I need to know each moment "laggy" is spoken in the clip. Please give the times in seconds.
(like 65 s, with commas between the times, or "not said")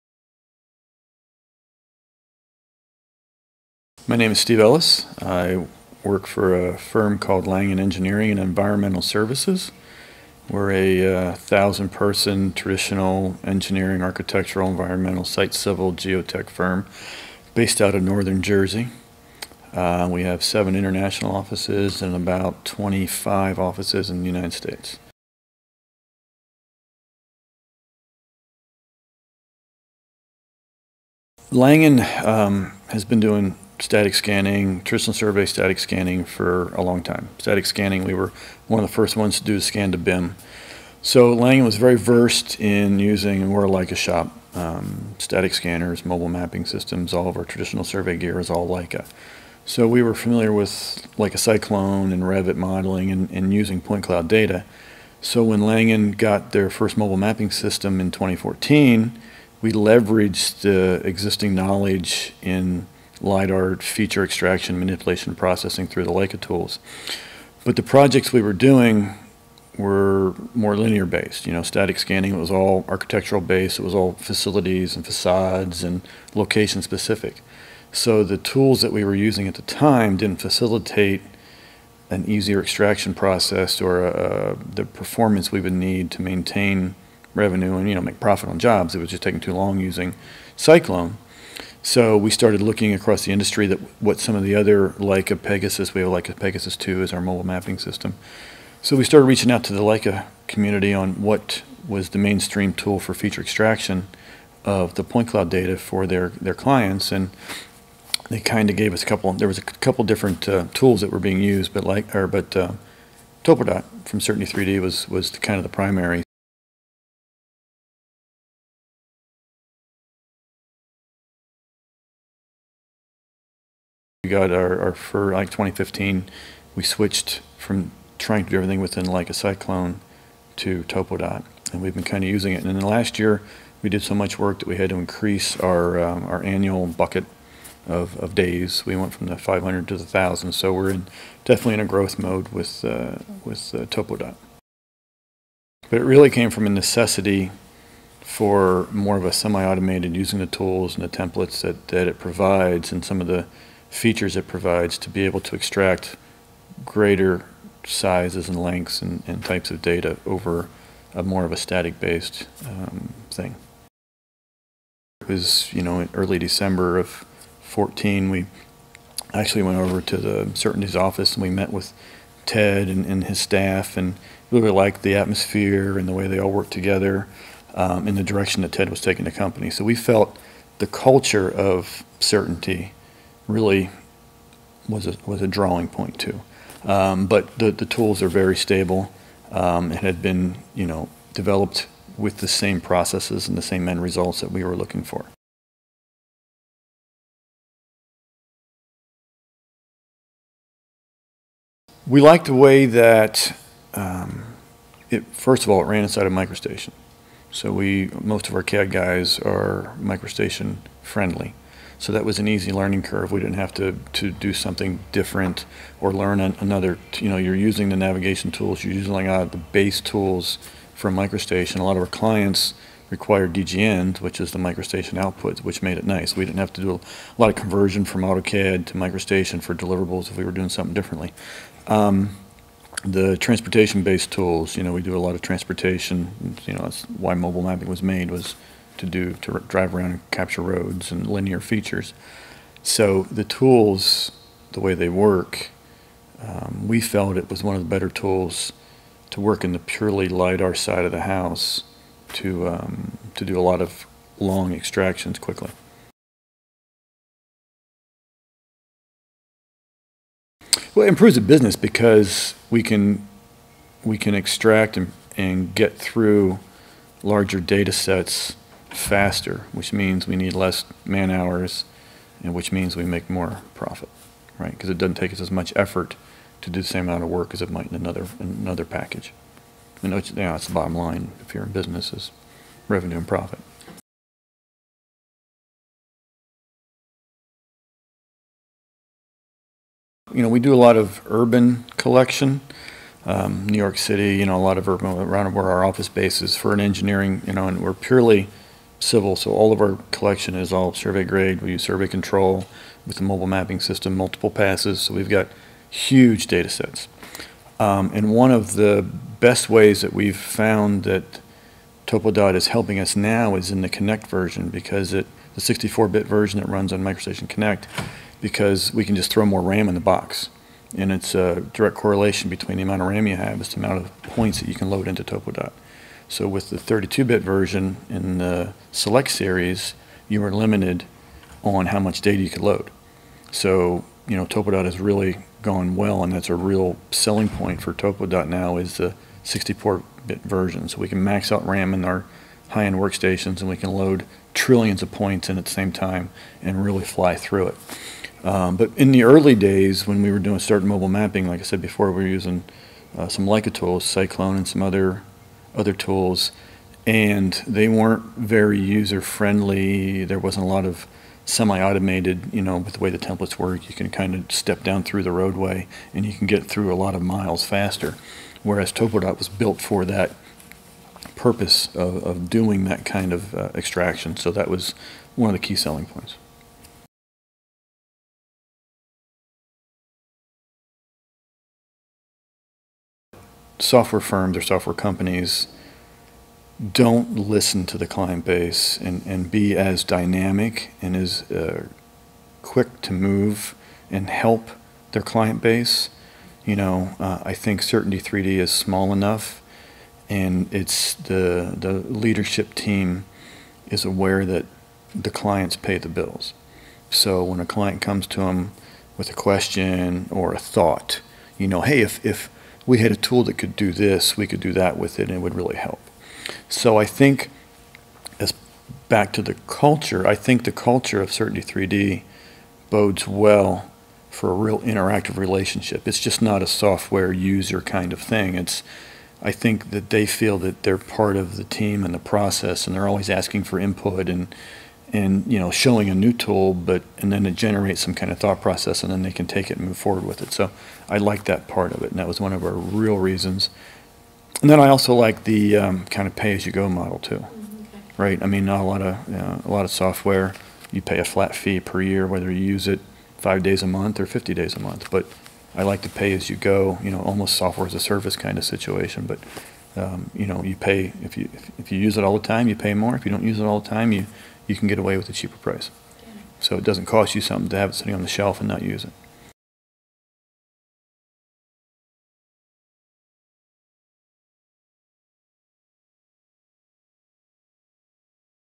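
not said.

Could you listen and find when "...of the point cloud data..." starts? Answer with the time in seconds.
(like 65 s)
104 s.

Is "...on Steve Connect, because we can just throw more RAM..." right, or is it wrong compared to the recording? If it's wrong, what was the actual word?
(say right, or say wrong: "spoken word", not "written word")
wrong: "MicroStation", not "Steve".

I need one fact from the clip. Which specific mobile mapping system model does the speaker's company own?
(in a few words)
Leica Pegasus 2.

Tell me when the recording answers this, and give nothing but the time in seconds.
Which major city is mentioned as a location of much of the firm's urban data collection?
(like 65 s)
293 s.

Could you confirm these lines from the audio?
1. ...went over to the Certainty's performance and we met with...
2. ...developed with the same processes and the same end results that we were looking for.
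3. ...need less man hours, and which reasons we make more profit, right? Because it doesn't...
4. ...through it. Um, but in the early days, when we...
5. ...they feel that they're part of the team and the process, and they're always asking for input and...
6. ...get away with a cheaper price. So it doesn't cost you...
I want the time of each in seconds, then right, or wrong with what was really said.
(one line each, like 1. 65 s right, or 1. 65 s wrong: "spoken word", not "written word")
1. 169 s wrong: "office", not "performance"
2. 191 s right
3. 270 s wrong: "means", not "reasons"
4. 347 s right
5. 430 s right
6. 464 s right.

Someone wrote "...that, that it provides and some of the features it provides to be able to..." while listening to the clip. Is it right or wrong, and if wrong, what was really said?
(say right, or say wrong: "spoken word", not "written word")
right.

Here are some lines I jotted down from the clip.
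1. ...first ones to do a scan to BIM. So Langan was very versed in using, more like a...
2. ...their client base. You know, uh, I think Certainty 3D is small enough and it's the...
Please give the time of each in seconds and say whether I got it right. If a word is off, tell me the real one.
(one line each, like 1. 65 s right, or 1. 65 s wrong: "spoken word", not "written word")
1. 38 s right
2. 395 s right.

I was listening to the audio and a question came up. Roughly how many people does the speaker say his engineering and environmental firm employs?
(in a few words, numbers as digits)
1000.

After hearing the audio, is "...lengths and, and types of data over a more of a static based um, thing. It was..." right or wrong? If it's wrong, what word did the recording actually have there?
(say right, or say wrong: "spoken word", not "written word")
right.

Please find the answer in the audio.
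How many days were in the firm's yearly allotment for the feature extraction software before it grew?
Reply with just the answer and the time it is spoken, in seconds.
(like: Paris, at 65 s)
500, at 139 s.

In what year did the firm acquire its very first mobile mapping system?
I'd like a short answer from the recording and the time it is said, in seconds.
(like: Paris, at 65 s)
2014, at 58 s.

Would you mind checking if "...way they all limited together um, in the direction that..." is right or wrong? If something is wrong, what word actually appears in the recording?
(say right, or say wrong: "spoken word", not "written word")
wrong: "worked", not "limited".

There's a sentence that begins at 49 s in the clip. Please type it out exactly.
So we were familiar with Leica Cyclone and Revit modeling and, and using point cloud data.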